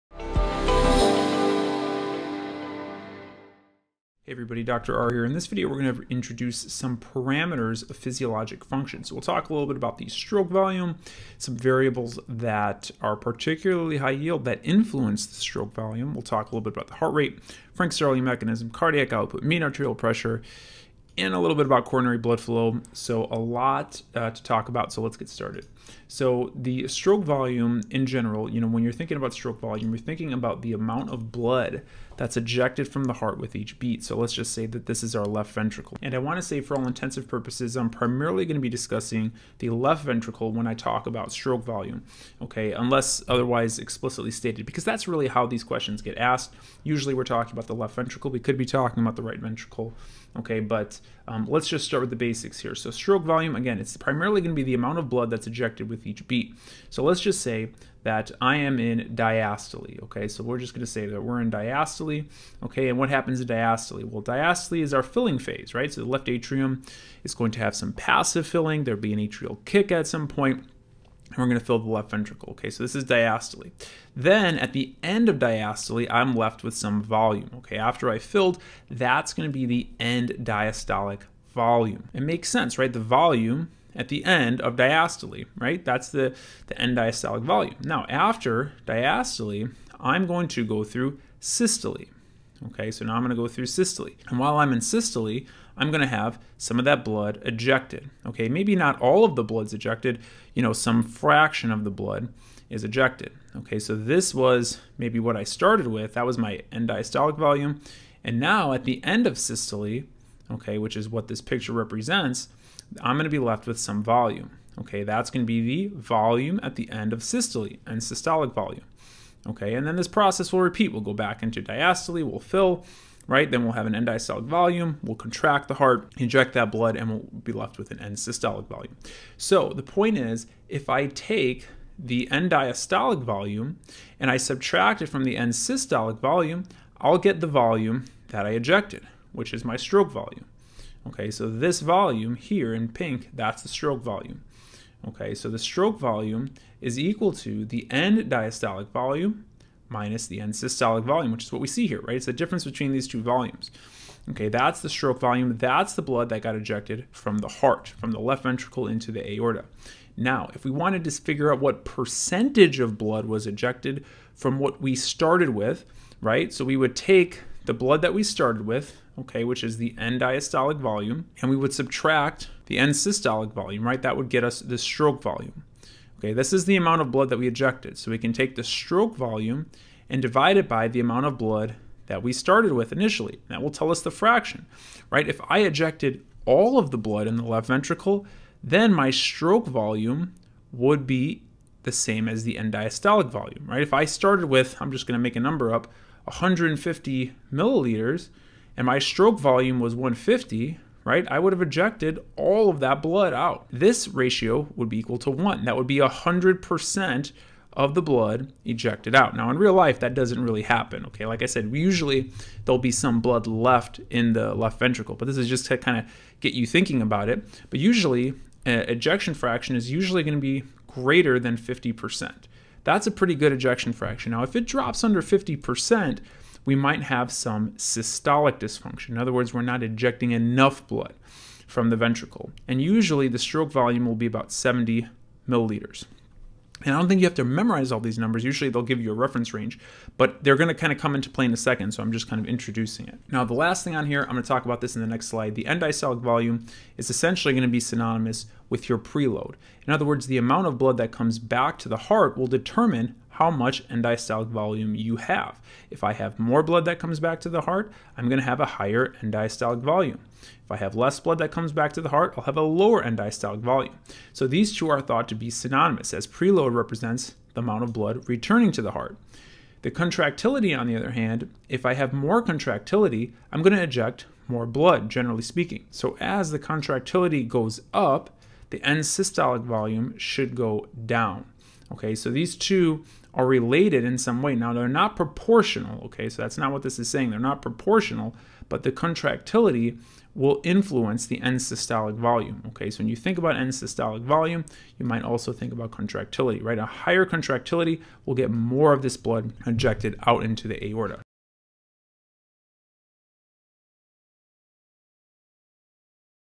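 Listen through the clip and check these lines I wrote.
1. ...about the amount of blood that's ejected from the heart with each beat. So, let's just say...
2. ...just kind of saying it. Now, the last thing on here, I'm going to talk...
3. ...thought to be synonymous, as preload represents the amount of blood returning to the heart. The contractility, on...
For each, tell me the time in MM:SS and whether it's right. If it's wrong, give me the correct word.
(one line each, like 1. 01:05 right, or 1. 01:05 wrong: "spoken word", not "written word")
1. 00:30 right
2. 04:02 wrong: "introducing", not "saying"
3. 04:25 right.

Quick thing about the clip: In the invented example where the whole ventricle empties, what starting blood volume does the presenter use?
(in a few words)
150 milliliters.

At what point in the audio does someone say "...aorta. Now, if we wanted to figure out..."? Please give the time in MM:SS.
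02:39.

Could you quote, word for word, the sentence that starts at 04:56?
A higher contractility will get more of this blood ejected out into the aorta.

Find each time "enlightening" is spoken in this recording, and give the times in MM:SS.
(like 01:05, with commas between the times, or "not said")
not said.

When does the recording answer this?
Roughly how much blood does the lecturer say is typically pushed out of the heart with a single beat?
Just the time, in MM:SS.
03:54.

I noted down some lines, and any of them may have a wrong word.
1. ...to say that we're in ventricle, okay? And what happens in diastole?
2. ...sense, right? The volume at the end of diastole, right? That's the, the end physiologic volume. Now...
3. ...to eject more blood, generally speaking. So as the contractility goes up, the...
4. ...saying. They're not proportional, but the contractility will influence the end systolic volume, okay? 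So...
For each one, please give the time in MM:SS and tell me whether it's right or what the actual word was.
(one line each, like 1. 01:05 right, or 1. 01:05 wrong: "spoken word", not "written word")
1. 01:00 wrong: "diastole", not "ventricle"
2. 01:22 wrong: "diastolic", not "physiologic"
3. 04:33 right
4. 04:47 right.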